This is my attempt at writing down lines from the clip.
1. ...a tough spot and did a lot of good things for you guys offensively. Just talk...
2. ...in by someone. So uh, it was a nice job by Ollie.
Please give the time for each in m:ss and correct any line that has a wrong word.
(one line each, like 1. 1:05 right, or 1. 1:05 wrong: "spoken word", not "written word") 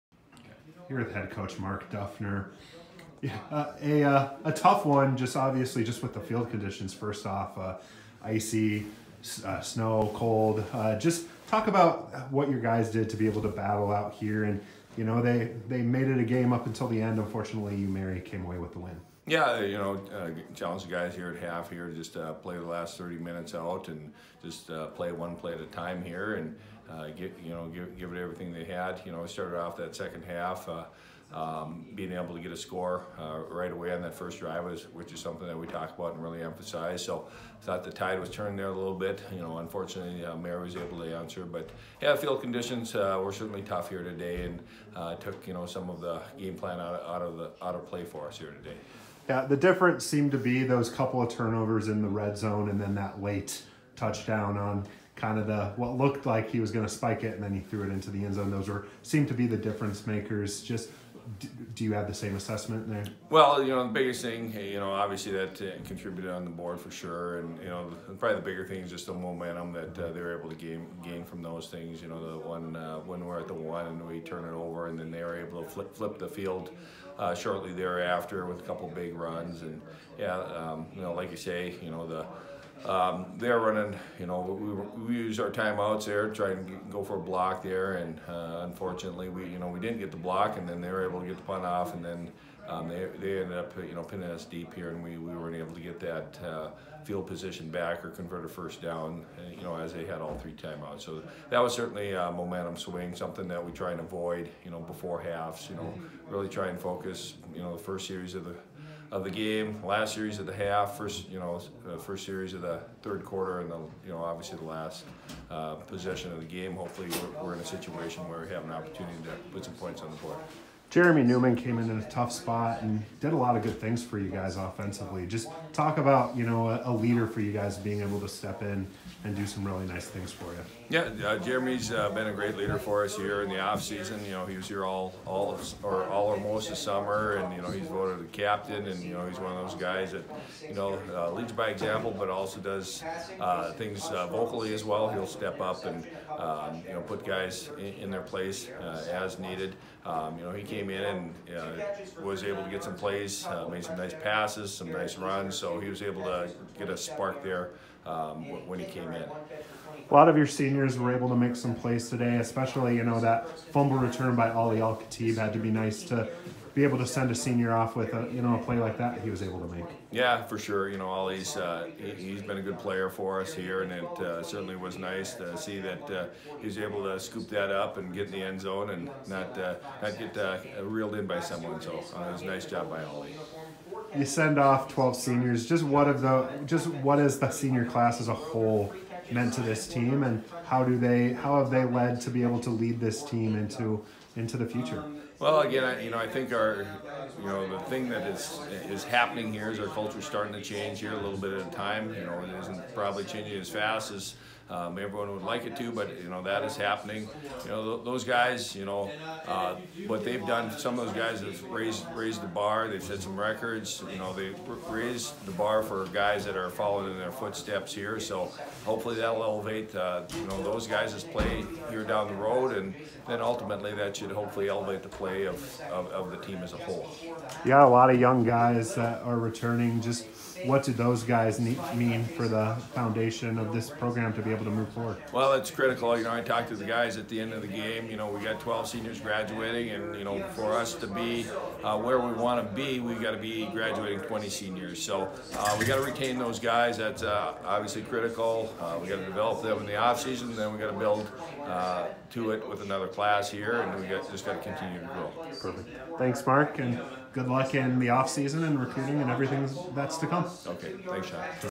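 1. 2:01 right
2. 3:01 right.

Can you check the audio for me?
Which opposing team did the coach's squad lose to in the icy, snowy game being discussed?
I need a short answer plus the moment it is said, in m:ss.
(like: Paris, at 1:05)
U-Mary, at 0:17.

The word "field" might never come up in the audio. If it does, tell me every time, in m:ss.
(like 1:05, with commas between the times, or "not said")
0:06, 0:42, 1:16, 1:37.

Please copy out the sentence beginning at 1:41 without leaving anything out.
So that was certainly uh, a momentum swing, something that we try and avoid, you know, before halves, you know, mm-hmm.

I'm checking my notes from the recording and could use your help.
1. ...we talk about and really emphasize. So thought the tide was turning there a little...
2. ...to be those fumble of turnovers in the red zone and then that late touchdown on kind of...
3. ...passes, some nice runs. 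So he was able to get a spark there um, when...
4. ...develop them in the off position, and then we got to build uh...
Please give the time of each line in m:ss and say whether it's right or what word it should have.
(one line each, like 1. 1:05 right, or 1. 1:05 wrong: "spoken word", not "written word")
1. 0:35 right
2. 0:50 wrong: "couple", not "fumble"
3. 2:34 right
4. 4:09 wrong: "season", not "position".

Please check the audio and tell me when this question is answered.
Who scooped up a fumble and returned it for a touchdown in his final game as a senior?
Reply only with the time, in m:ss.
2:44.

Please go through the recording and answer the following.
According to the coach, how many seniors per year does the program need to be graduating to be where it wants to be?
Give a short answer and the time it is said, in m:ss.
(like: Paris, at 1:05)
20, at 4:04.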